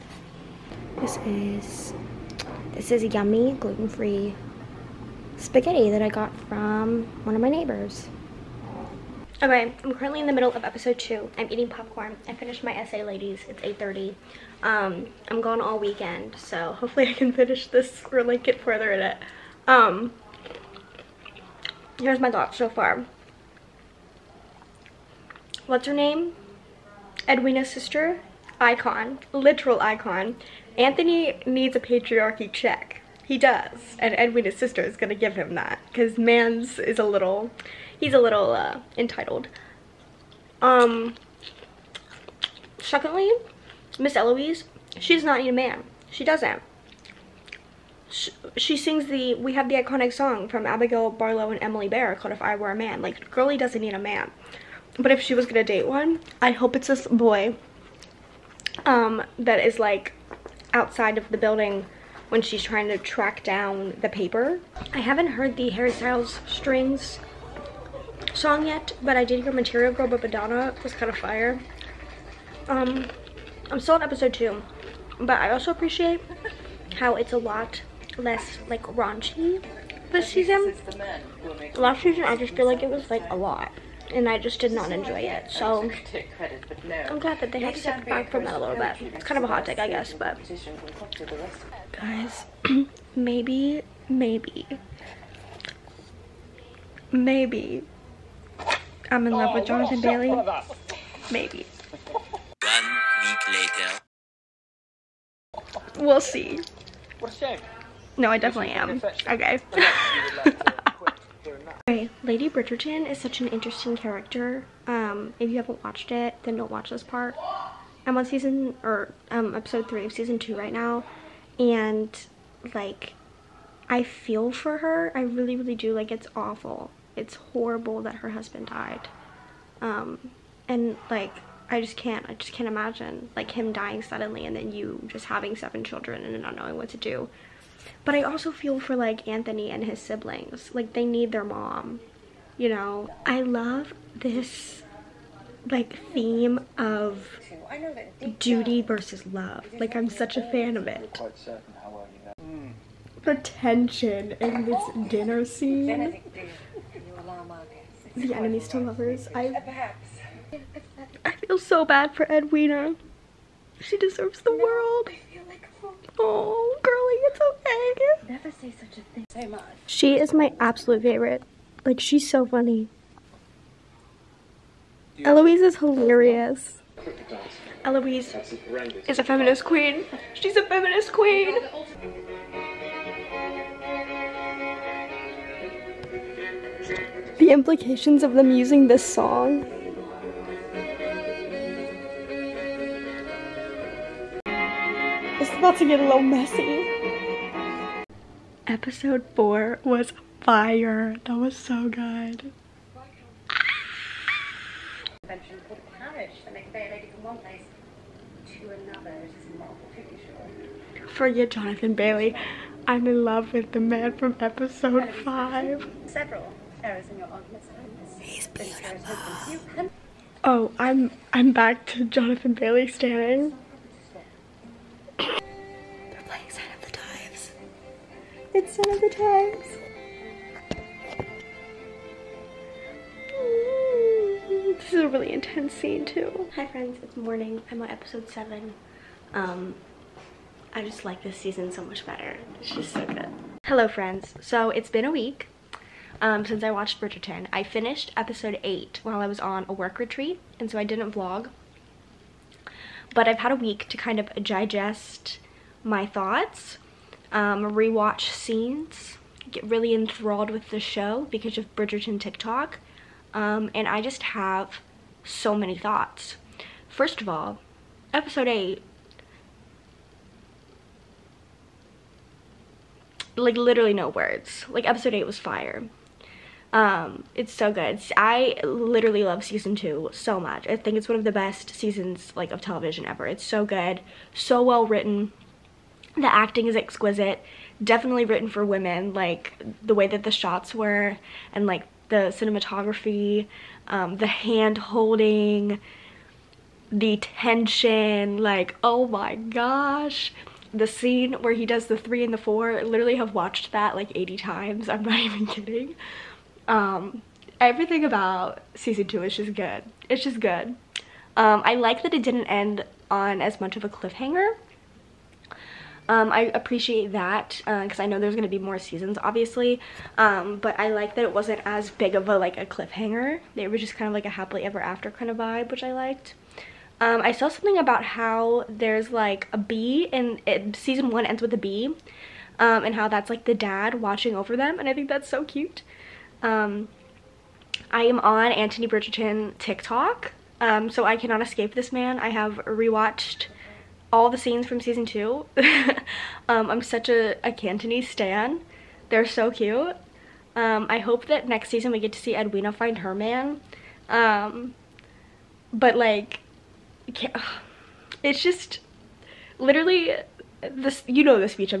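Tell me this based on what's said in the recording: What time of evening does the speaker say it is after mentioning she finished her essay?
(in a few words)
8:30.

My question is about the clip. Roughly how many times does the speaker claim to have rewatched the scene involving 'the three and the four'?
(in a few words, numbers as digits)
80.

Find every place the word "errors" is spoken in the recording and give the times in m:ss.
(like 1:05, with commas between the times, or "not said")
3:36.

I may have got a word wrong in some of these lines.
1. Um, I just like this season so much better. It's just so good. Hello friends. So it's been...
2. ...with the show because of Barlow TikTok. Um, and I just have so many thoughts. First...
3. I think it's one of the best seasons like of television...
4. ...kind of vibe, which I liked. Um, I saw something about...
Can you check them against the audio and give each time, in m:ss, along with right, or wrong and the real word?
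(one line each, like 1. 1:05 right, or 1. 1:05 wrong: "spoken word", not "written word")
1. 3:59 right
2. 4:20 wrong: "Bridgerton", not "Barlow"
3. 4:40 right
4. 5:25 right.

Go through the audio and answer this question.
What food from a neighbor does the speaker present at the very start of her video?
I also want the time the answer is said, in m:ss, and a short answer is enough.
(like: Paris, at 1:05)
gluten-free spaghetti, at 0:03.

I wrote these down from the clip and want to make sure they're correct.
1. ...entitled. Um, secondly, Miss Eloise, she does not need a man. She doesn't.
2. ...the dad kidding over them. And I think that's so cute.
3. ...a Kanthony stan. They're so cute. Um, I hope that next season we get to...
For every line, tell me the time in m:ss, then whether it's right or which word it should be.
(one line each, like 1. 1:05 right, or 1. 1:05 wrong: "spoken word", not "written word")
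1. 0:38 right
2. 5:33 wrong: "watching", not "kidding"
3. 5:47 right.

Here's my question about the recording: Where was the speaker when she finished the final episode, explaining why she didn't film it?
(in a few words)
a work retreat.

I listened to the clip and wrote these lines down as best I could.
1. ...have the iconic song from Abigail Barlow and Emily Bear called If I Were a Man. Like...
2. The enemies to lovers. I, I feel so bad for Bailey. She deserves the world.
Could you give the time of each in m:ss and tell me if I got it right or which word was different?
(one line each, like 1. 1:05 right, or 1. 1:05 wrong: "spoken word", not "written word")
1. 0:49 right
2. 2:38 wrong: "Edwina", not "Bailey".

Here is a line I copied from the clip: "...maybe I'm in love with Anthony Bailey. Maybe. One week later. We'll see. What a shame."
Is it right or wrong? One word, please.
wrong.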